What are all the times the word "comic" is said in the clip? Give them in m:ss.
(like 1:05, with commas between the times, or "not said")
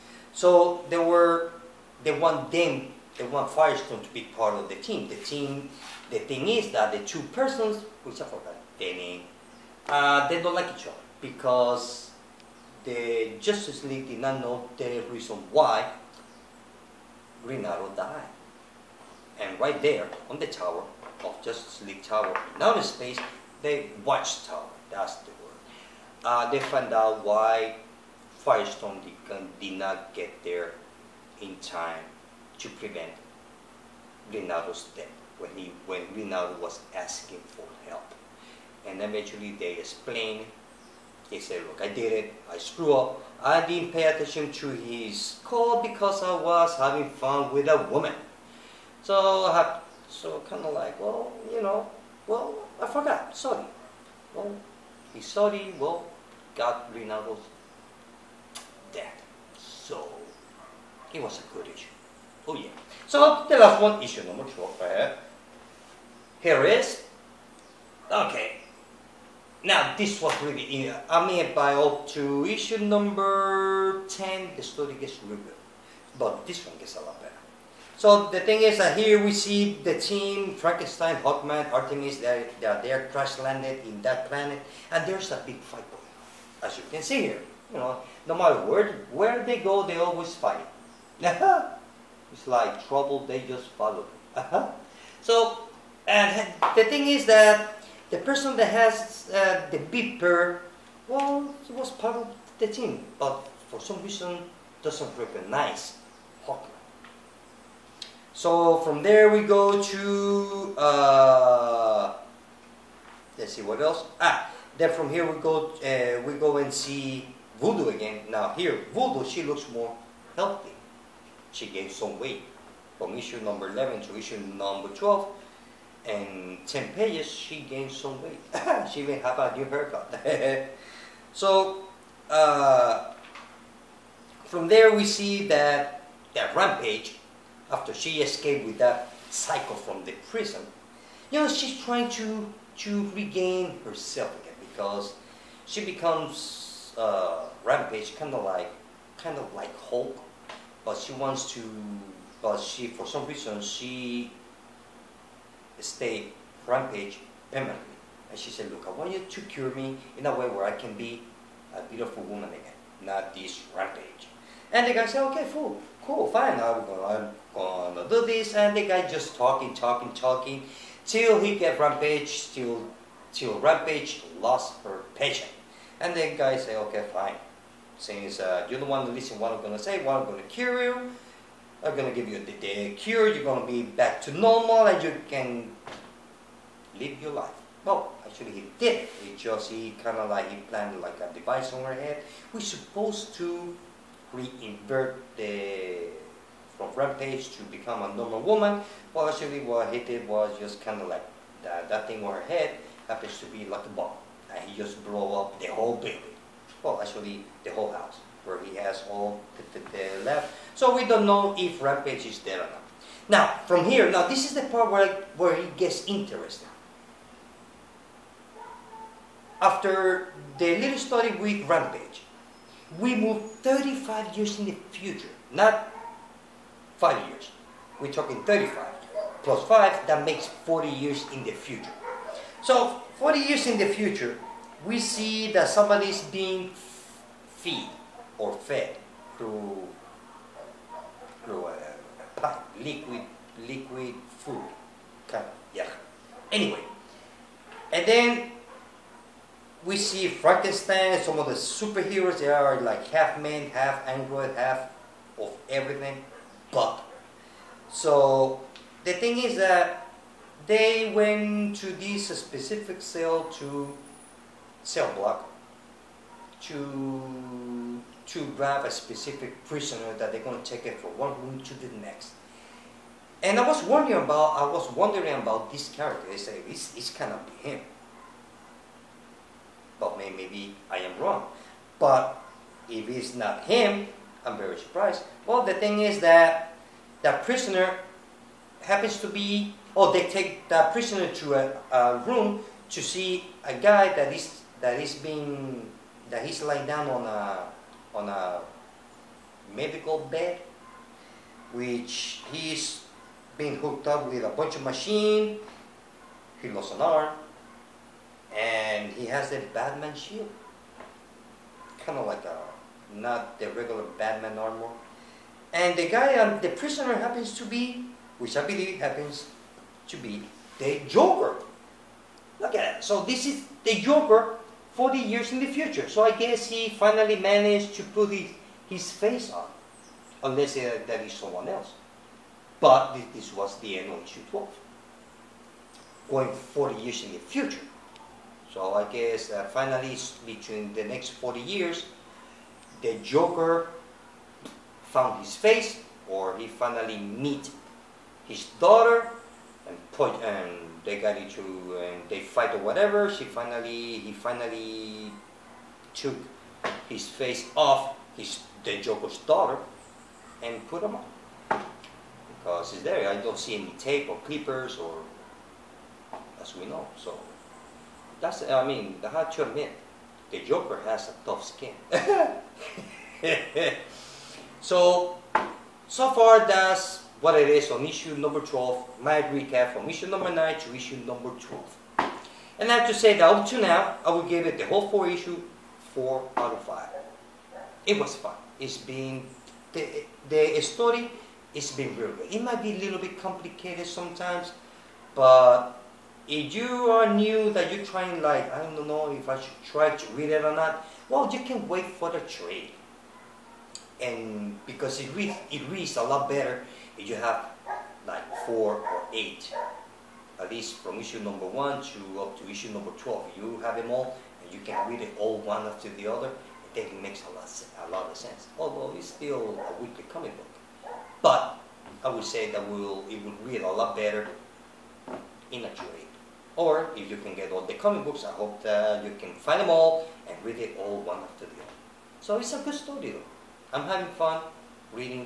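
7:00, 7:07.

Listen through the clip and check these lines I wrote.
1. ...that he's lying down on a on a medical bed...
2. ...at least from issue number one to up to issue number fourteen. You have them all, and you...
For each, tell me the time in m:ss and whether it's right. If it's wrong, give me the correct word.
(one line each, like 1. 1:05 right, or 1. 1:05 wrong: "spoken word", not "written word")
1. 4:56 right
2. 6:50 wrong: "twelve", not "fourteen".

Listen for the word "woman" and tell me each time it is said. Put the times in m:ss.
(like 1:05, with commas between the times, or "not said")
0:47, 2:42, 3:18.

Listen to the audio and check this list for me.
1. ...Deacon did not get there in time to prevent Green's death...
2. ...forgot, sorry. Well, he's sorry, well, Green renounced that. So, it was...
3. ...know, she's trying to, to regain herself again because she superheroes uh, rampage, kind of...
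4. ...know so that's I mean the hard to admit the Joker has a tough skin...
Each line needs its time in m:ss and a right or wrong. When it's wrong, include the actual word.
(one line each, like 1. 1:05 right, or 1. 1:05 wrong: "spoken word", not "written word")
1. 0:29 wrong: "Rinaldo", not "Green"
2. 0:52 wrong: "God", not "Green"
3. 2:21 wrong: "becomes", not "superheroes"
4. 6:06 right.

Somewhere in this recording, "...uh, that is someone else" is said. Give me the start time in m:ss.
5:30.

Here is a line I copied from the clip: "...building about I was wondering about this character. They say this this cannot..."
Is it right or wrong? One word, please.
wrong.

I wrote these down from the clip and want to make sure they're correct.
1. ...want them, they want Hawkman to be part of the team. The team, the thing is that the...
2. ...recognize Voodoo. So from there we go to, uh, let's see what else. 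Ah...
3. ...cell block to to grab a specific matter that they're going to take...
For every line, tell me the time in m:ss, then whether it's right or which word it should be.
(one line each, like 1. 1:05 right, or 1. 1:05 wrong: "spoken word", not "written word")
1. 0:02 wrong: "Firestorm", not "Hawkman"
2. 1:45 wrong: "Hawkman", not "Voodoo"
3. 4:24 wrong: "prisoner", not "matter".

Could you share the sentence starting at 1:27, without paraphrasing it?
You know, no matter where, where they go, they always fight.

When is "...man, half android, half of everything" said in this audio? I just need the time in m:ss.
4:13.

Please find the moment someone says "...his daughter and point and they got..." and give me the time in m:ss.
5:48.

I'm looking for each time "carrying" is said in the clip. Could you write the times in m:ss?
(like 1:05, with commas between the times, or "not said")
not said.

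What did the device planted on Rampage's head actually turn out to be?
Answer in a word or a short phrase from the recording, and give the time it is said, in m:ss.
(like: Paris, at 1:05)
A bomb, at 3:23.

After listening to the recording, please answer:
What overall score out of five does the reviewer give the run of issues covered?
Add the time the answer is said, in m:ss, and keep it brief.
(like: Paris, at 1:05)
4 out of 5, at 6:26.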